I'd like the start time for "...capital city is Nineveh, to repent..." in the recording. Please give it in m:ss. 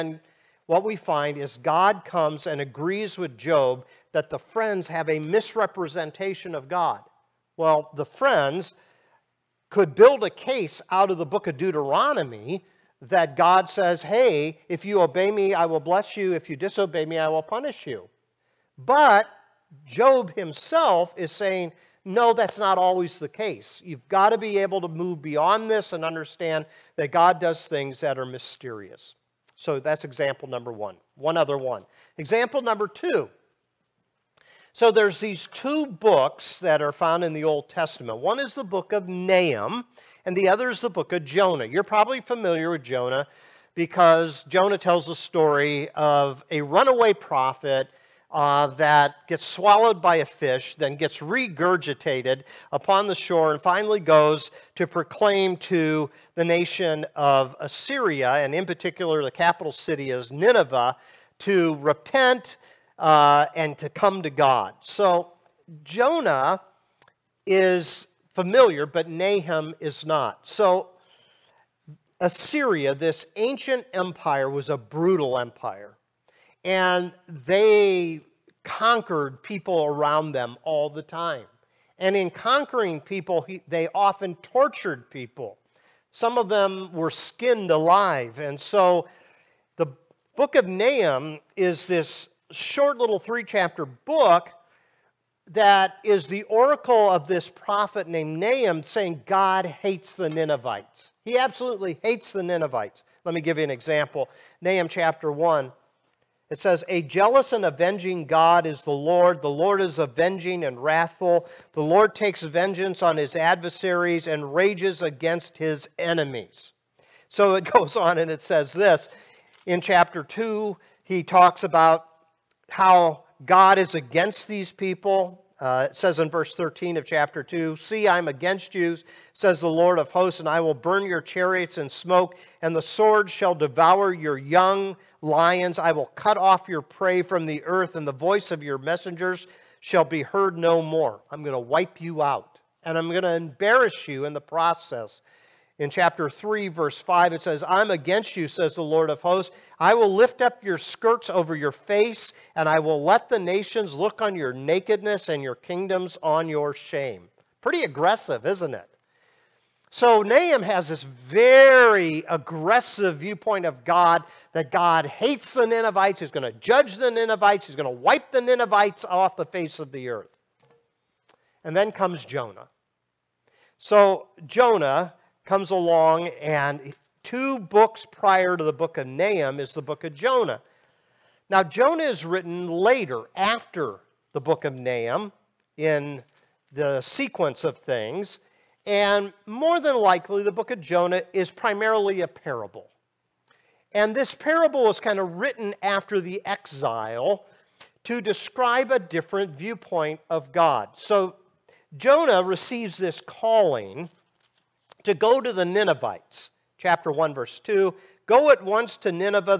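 0:59.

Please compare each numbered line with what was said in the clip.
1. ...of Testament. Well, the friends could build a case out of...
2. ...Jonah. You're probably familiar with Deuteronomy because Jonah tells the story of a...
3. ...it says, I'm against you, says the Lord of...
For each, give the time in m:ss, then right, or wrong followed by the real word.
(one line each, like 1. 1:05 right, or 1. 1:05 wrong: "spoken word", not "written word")
1. 0:06 wrong: "God", not "Testament"
2. 0:41 wrong: "Jonah", not "Deuteronomy"
3. 2:27 right.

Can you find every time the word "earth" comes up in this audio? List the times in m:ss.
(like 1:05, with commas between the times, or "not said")
2:17, 2:50.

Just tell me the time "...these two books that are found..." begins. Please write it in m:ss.
0:35.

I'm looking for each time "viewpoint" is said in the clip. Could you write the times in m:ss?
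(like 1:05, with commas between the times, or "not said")
2:43, 3:19.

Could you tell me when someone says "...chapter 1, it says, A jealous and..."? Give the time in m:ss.
1:44.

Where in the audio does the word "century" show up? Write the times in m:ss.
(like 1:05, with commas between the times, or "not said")
not said.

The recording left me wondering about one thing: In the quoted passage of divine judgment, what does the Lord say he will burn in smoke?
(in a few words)
Your chariots.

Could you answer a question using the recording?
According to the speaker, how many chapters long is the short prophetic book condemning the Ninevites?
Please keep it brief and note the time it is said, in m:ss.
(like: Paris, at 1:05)
3, at 1:33.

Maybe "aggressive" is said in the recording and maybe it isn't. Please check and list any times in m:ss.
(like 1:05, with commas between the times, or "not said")
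2:37, 2:42.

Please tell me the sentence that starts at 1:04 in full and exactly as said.
So Jonah is familiar, but Nahum is not.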